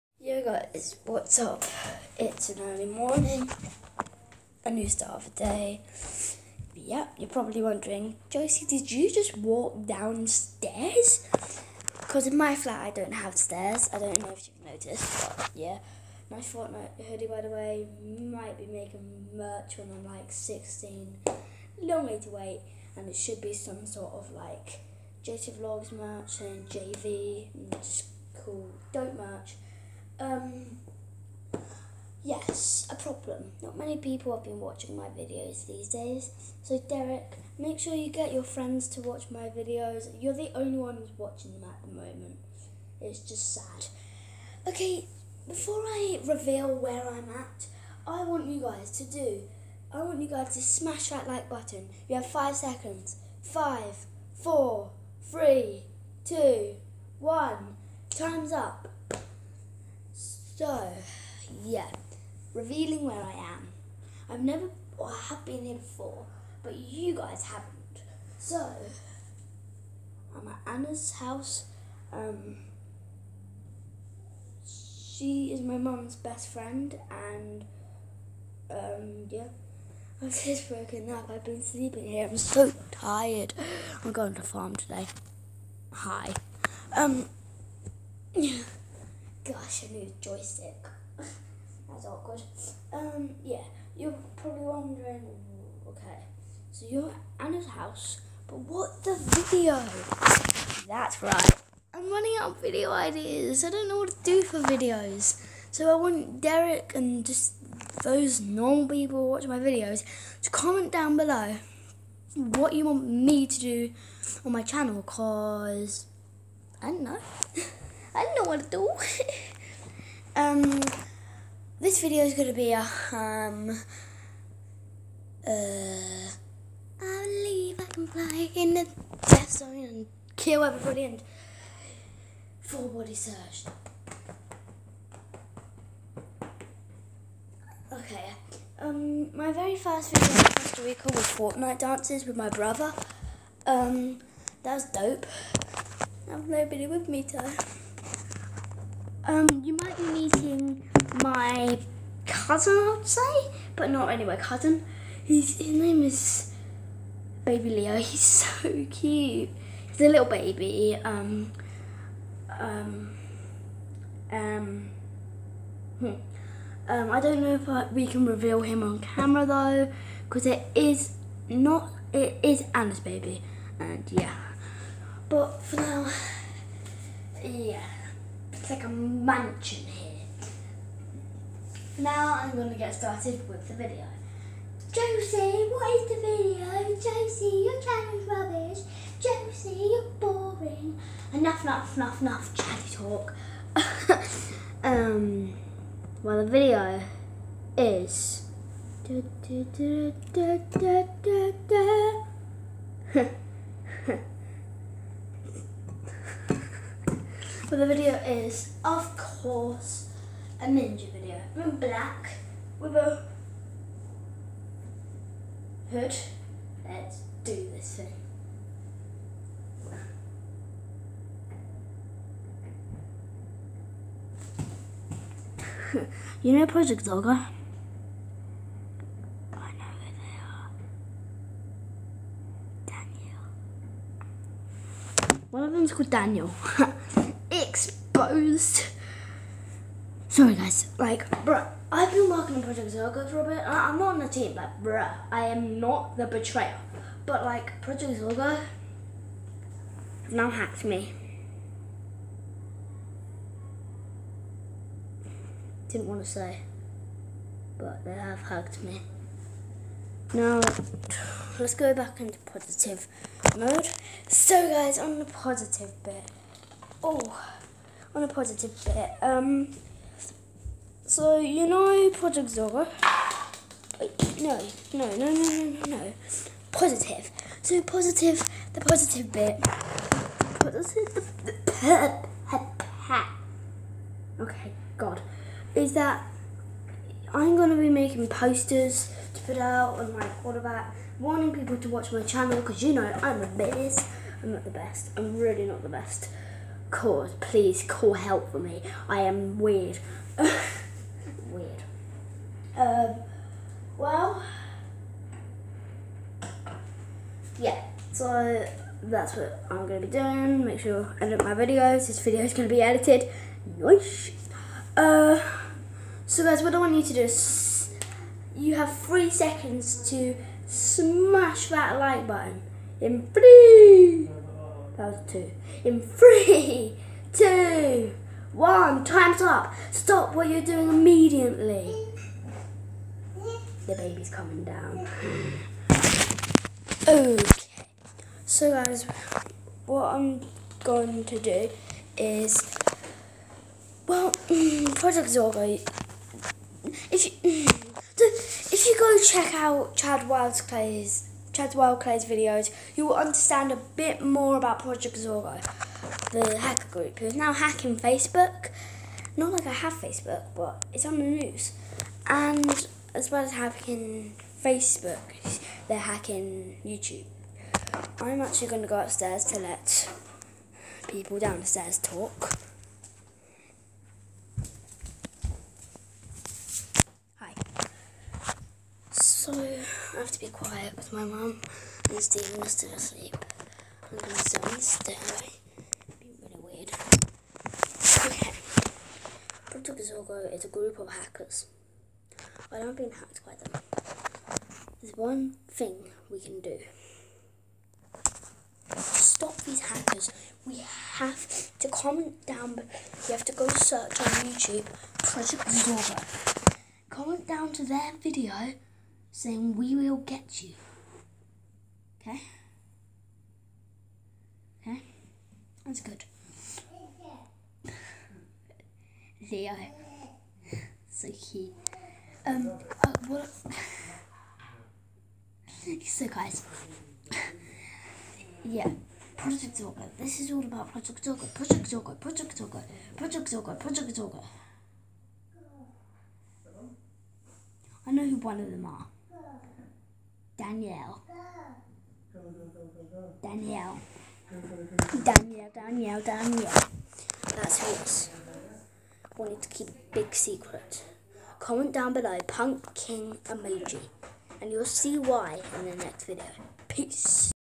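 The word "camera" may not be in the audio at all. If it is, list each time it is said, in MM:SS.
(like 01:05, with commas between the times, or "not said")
02:48.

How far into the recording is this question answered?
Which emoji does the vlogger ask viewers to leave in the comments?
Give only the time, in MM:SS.
07:32.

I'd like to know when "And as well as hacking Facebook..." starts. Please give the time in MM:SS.
06:02.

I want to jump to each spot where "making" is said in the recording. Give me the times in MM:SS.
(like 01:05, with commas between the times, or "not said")
00:18, 04:47.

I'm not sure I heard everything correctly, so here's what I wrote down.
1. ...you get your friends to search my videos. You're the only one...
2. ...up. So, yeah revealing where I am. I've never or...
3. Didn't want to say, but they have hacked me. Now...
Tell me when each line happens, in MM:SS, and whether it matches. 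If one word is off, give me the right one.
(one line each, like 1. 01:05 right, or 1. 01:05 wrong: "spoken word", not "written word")
1. 00:37 wrong: "watch", not "search"
2. 00:58 right
3. 04:15 right.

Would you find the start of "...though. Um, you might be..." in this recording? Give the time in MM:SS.
02:27.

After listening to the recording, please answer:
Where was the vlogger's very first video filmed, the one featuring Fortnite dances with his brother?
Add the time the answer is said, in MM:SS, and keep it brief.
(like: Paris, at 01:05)
Costa Rica, at 02:20.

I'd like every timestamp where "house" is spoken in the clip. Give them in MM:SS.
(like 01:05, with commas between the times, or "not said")
01:11, 01:37.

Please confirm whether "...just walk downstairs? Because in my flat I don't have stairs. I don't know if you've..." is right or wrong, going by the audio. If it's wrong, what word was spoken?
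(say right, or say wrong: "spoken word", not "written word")
right.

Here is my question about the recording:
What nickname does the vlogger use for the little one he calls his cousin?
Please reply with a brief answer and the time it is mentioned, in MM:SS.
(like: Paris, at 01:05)
Baby Leo, at 02:37.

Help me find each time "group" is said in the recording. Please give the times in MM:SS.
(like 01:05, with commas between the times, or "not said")
05:56, 06:30.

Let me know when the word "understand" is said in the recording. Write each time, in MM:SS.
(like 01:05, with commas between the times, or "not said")
05:53.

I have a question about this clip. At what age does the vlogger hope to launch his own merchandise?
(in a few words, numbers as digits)
16.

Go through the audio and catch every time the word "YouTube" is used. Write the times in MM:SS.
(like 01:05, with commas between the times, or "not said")
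06:06, 06:44.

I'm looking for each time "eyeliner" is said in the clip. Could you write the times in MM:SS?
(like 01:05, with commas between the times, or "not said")
not said.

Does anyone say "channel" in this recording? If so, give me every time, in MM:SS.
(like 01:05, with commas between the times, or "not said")
01:54, 03:07, 04:52.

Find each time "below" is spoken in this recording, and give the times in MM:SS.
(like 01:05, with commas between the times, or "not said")
01:51, 07:32.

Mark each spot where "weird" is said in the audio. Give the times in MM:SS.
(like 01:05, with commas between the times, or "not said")
04:59, 06:26.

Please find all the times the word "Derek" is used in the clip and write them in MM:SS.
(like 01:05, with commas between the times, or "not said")
00:36, 01:46.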